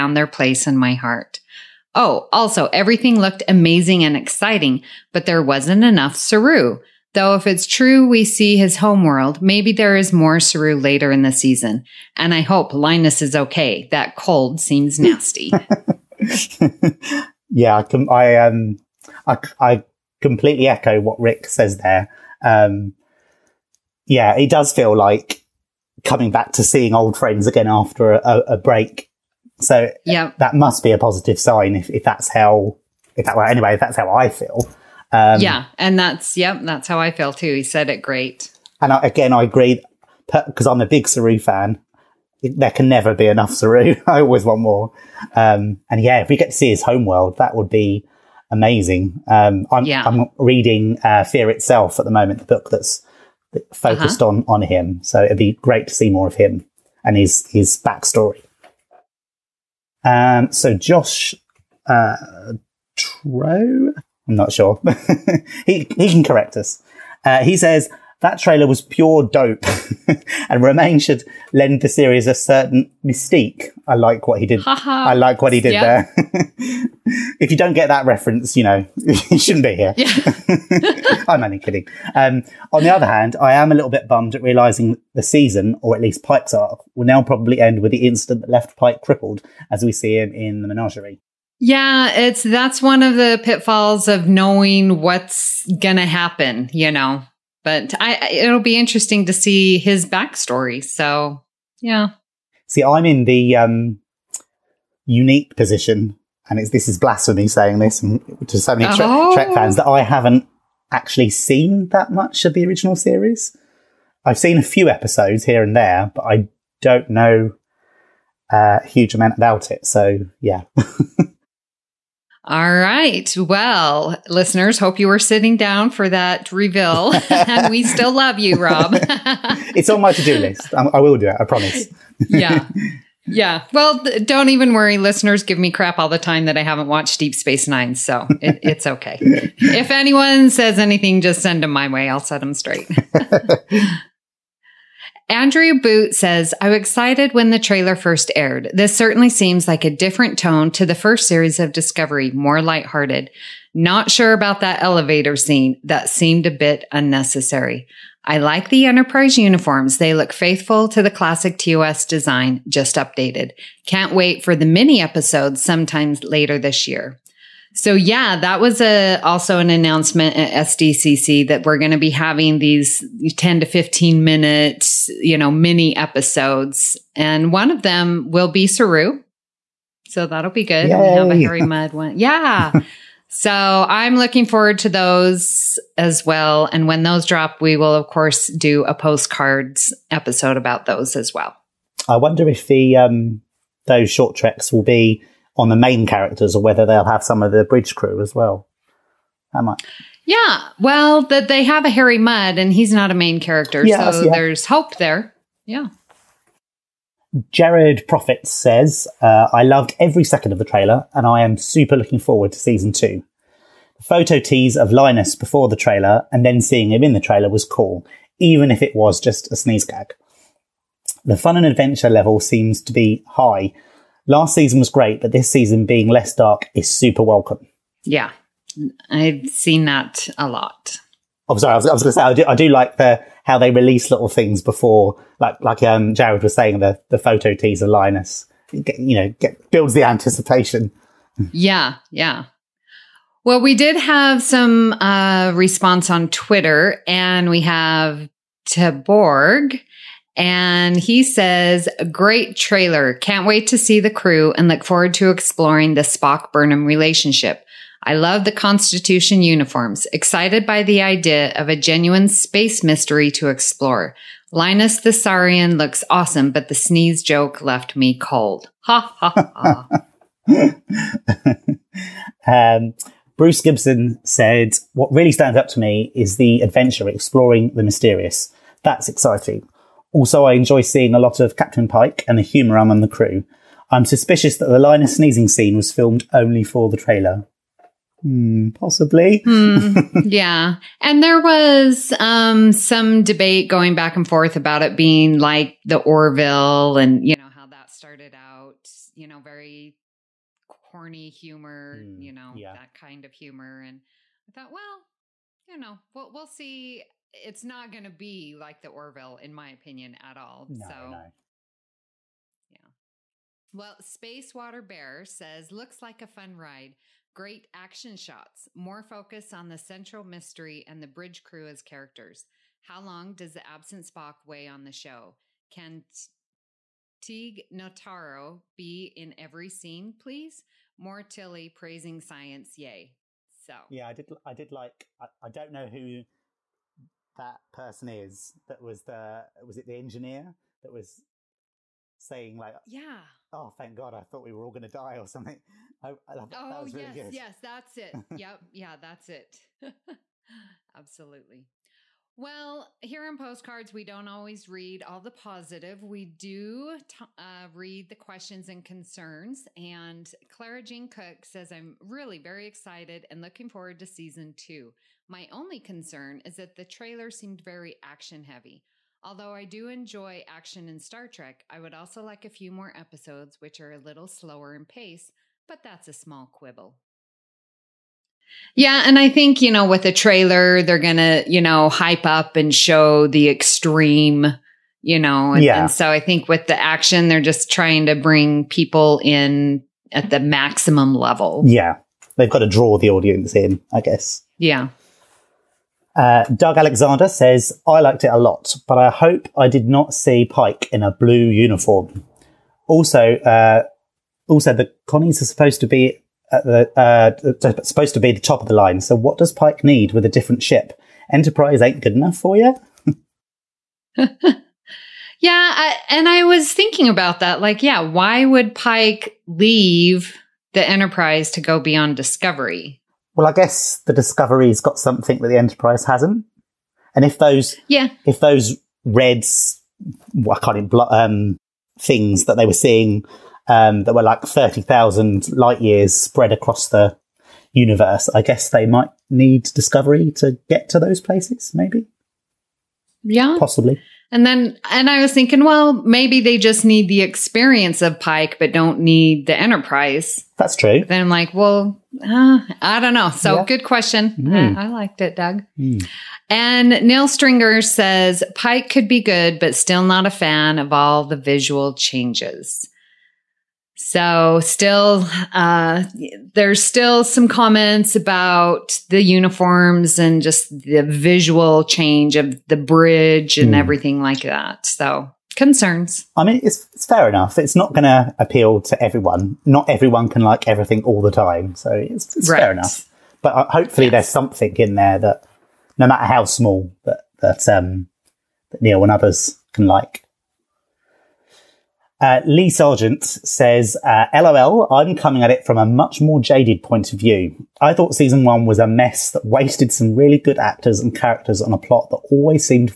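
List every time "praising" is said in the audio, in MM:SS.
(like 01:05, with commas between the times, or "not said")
05:31.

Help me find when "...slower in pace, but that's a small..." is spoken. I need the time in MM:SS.
06:14.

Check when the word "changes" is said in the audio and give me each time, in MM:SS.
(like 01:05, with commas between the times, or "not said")
07:41, 07:51.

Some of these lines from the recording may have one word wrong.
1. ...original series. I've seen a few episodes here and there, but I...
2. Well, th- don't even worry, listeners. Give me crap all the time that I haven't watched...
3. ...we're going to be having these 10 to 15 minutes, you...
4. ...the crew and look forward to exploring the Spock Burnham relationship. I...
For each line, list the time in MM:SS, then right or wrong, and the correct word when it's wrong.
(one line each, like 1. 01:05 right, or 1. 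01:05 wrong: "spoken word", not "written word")
1. 01:52 right
2. 02:13 right
3. 02:51 right
4. 04:13 right.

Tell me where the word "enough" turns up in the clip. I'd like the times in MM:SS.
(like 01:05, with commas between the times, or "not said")
00:05, 00:43, 06:52, 07:57, 08:02.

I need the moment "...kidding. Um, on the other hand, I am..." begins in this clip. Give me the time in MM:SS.
01:21.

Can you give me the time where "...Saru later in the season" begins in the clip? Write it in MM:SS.
00:10.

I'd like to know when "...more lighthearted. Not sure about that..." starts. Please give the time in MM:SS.
02:32.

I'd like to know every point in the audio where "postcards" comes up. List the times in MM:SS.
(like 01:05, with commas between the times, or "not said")
03:08, 05:53.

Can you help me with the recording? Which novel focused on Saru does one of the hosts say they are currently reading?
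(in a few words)
Fear Itself.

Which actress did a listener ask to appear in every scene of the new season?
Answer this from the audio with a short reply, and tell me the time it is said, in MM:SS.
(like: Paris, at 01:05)
Tig Notaro, at 05:27.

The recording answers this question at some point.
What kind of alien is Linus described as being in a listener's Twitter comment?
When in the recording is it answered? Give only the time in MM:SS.
04:25.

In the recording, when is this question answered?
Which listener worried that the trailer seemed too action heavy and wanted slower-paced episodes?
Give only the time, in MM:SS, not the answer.
06:00.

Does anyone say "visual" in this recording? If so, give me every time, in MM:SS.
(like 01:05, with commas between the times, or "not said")
07:41, 07:51.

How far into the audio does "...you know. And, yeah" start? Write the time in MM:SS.
06:25.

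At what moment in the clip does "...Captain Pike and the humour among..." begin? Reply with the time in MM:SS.
04:41.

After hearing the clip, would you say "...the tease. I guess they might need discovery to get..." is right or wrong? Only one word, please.
wrong.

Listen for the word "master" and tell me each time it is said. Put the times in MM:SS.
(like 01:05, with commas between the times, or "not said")
not said.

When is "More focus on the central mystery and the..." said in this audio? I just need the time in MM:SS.
05:18.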